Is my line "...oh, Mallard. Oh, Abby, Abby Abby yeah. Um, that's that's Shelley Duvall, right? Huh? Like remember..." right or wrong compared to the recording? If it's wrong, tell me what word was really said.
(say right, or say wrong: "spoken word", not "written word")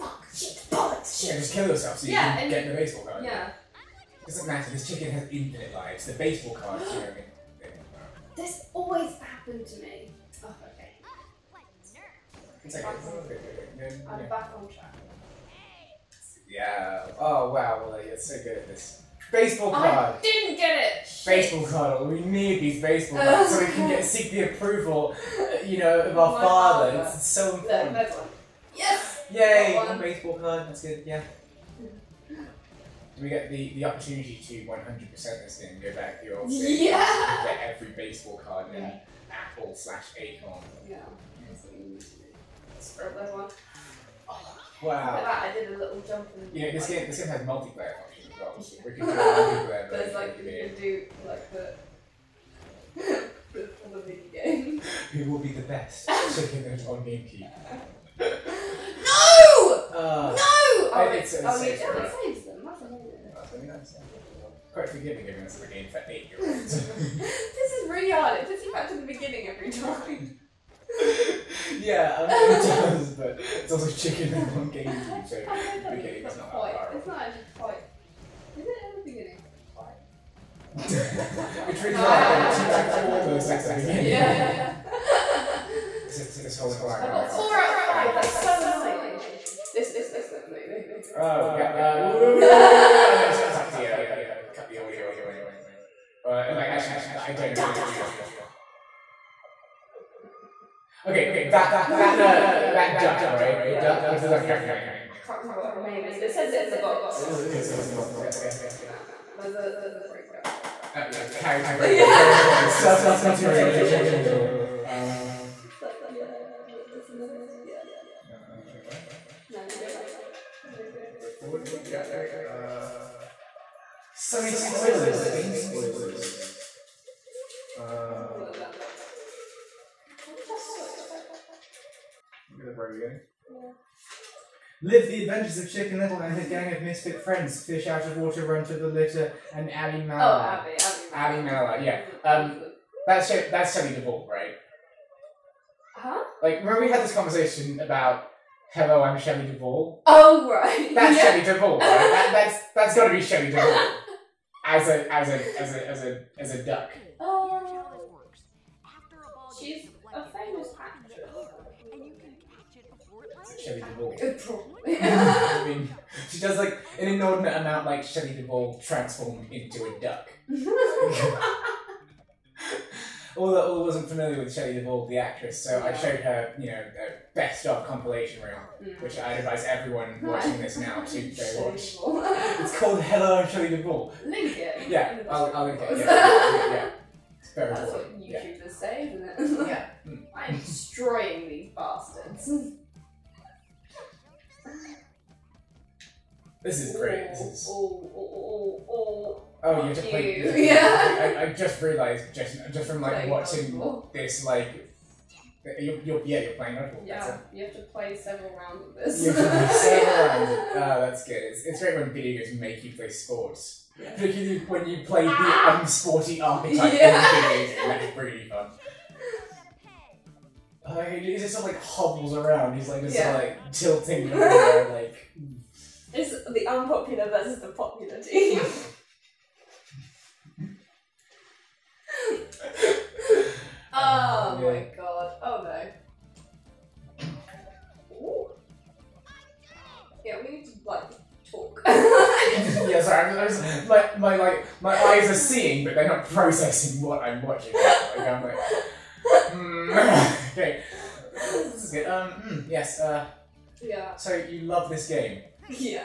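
right.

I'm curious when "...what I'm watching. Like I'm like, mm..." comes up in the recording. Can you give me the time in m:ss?
4:07.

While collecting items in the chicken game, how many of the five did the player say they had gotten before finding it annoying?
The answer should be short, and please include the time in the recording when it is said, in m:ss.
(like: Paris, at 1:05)
4, at 1:27.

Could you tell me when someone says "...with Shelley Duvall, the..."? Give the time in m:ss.
2:54.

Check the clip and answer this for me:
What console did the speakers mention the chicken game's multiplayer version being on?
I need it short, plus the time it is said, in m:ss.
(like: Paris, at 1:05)
GameCube, at 0:57.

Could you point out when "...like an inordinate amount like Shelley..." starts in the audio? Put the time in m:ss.
2:46.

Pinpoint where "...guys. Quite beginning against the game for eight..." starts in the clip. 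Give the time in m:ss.
1:03.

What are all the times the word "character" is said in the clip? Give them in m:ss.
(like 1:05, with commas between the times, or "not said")
1:44, 1:51.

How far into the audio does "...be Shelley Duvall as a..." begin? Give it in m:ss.
2:33.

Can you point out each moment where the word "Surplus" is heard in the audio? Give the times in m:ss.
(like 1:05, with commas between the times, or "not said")
1:52.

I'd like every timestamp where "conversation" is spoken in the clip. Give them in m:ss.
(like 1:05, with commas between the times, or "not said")
2:27.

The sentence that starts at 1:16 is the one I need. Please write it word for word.
that far It's not actually quite.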